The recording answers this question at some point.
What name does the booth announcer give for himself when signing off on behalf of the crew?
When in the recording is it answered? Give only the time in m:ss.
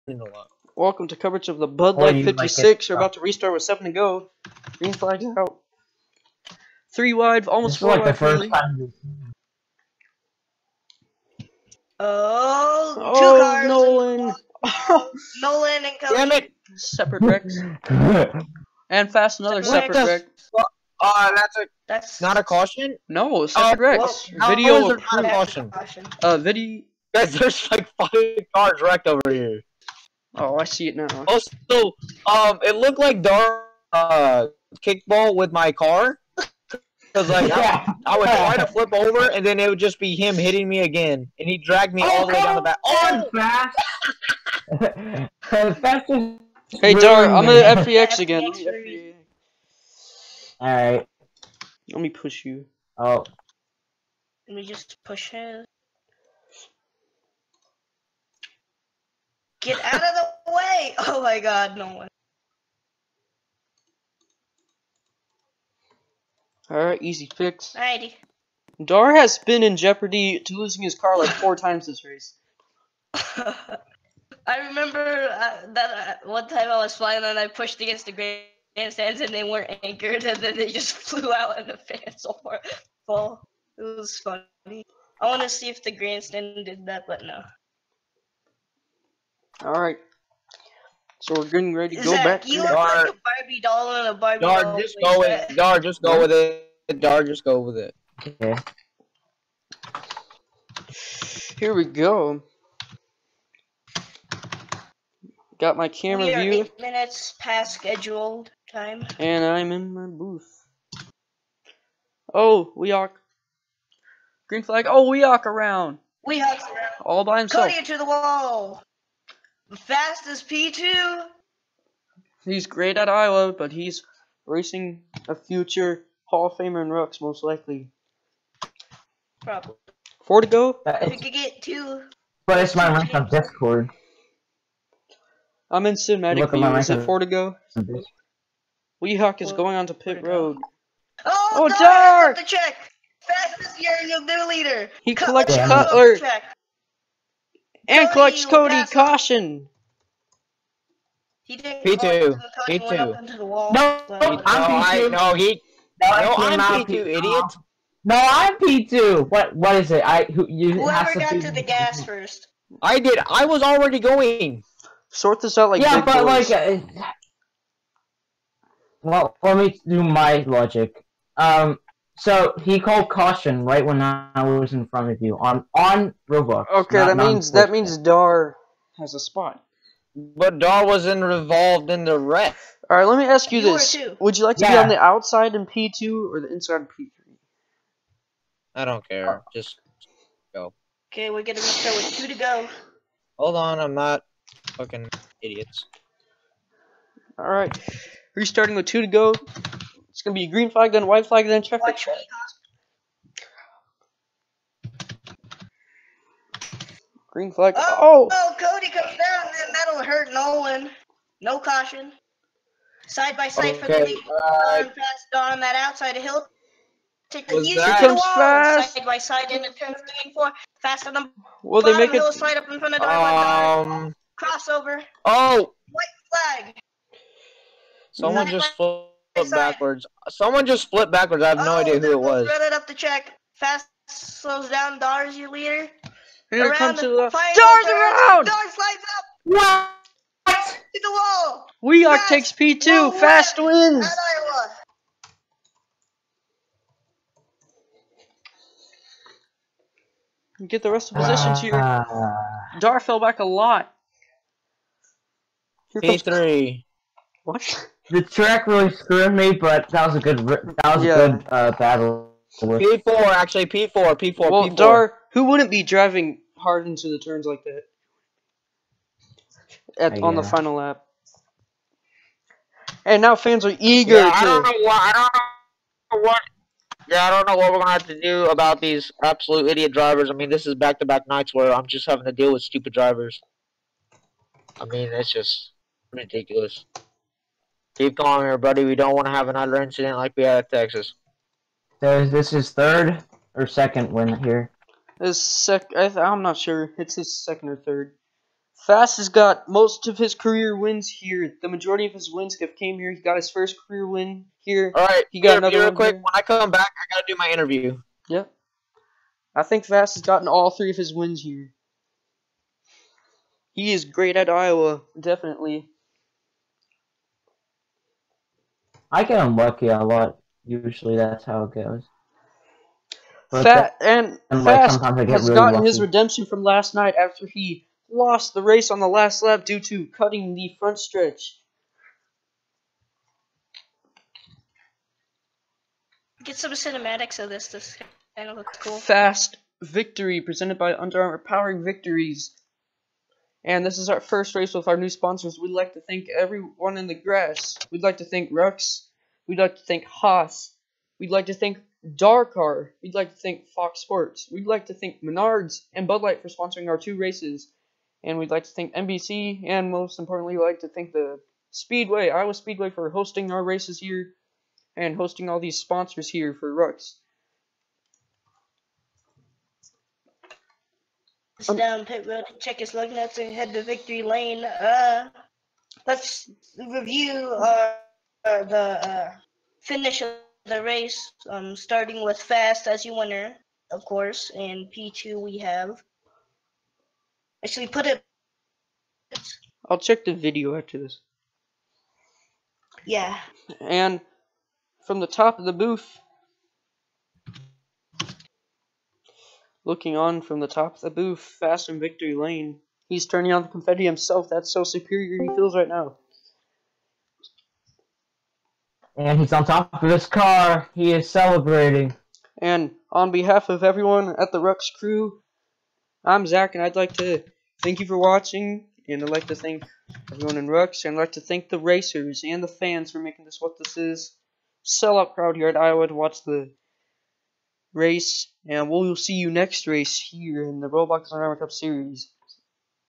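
6:56.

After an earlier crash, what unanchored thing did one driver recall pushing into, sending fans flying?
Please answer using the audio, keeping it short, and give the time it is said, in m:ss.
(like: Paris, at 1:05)
grandstands, at 1:18.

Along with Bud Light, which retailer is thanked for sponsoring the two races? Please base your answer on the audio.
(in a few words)
Menards.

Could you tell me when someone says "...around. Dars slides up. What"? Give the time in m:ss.
3:57.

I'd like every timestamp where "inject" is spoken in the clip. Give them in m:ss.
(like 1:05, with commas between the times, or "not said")
not said.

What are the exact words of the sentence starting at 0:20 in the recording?
Uh, that's a that's not a caution.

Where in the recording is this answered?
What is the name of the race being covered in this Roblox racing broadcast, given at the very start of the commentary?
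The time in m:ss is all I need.
0:01.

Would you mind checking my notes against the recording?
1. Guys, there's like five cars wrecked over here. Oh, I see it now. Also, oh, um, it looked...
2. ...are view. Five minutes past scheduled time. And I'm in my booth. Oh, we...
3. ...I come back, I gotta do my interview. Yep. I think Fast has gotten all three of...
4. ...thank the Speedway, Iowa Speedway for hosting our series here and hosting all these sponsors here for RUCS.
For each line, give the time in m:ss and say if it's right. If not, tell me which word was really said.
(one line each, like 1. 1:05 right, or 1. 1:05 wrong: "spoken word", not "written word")
1. 0:27 right
2. 1:46 wrong: "Eight", not "Five"
3. 5:06 right
4. 6:00 wrong: "races", not "series".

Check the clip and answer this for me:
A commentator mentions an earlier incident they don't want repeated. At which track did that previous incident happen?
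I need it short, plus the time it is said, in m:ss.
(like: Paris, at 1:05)
Texas, at 4:50.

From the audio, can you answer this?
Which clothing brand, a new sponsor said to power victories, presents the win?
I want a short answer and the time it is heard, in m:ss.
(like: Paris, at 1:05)
Under Armour, at 5:40.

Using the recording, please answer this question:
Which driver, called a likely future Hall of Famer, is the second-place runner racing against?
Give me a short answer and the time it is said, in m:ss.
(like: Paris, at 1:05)
Rooks, at 2:06.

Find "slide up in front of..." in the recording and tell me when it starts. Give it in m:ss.
3:42.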